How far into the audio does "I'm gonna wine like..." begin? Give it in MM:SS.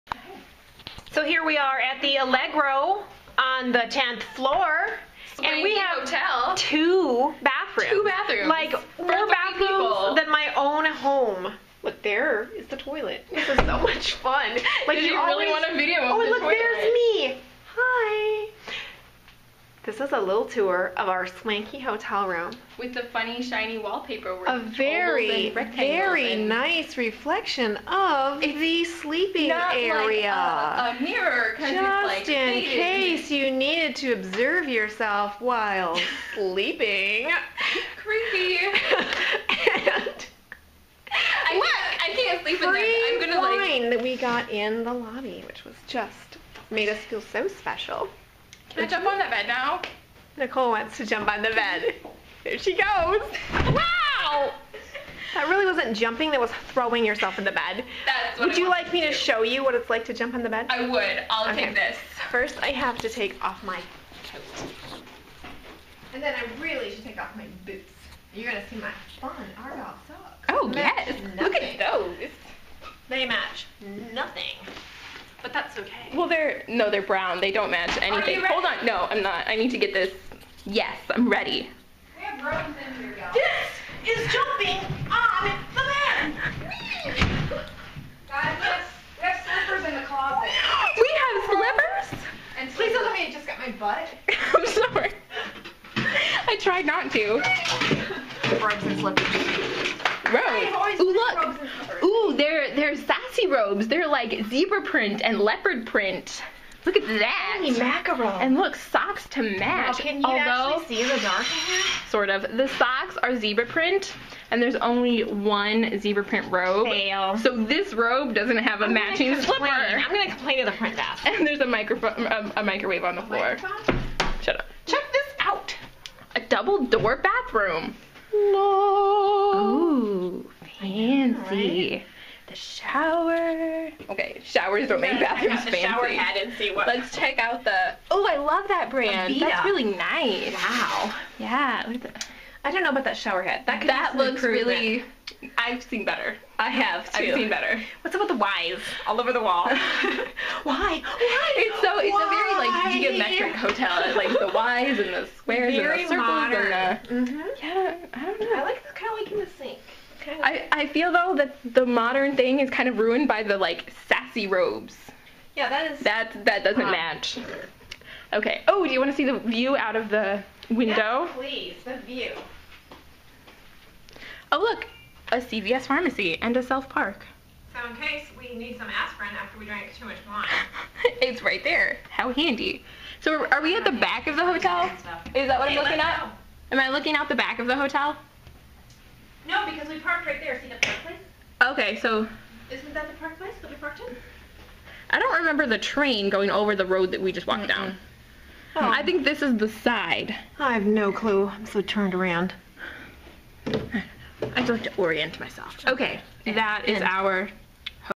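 00:43.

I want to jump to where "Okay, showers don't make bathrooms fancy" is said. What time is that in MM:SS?
02:14.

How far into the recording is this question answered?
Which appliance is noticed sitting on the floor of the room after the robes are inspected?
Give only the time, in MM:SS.
02:02.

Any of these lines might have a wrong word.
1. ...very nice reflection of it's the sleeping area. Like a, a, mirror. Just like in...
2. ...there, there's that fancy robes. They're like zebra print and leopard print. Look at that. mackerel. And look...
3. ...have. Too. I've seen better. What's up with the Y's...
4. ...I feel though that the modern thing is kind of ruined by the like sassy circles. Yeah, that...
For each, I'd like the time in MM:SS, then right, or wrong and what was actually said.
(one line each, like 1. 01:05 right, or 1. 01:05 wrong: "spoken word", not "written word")
1. 00:25 right
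2. 01:42 right
3. 02:26 right
4. 02:40 wrong: "robes", not "circles".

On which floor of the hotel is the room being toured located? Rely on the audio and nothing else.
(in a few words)
10th floor.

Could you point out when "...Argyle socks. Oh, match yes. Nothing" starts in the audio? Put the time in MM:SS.
01:09.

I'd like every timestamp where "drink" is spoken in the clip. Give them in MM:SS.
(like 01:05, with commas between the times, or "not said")
02:59.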